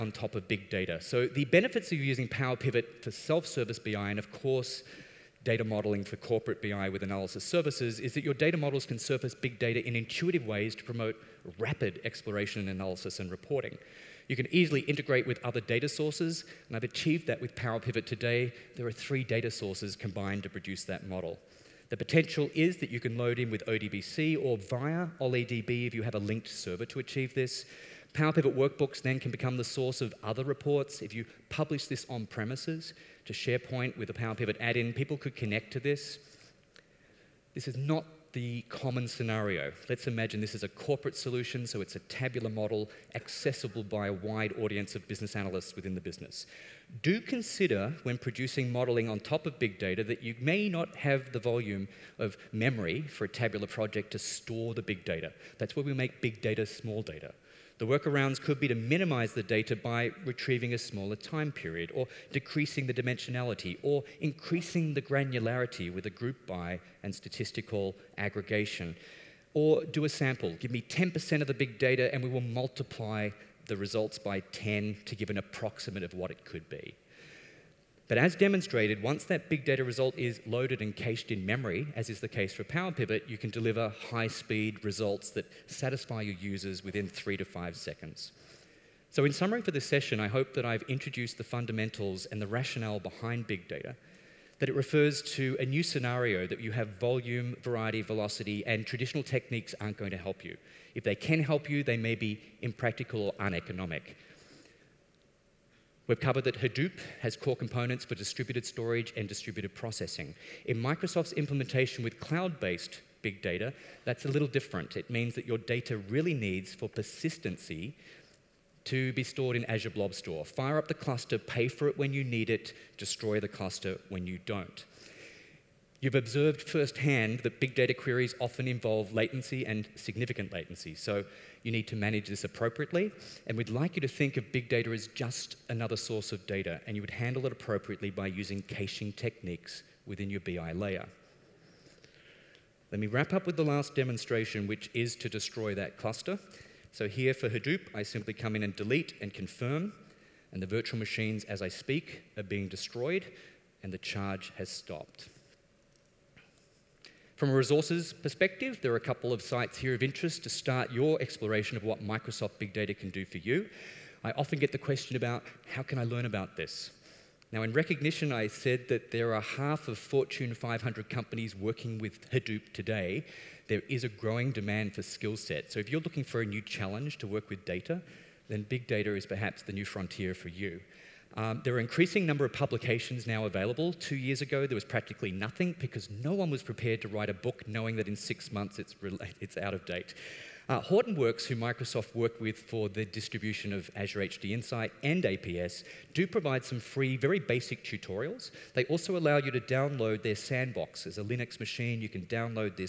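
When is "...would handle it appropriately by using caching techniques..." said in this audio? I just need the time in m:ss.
2:17.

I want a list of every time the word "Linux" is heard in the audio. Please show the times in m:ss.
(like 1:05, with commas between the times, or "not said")
3:21.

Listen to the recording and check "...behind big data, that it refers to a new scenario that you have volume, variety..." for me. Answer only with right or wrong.
right.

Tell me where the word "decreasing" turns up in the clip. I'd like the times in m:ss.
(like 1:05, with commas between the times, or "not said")
1:02.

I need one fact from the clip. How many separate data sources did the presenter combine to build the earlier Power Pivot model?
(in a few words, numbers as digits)
3.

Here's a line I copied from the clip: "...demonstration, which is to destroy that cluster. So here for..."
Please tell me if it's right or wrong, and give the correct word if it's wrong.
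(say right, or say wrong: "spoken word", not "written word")
right.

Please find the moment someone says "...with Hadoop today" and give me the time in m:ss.
2:51.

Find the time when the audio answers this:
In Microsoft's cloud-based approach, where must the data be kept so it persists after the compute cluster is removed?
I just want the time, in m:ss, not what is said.
1:59.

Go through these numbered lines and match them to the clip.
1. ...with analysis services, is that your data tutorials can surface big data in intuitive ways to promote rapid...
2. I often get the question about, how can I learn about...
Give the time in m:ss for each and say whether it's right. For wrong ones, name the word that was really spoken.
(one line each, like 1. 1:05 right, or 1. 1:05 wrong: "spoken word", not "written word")
1. 0:06 wrong: "models", not "tutorials"
2. 2:44 right.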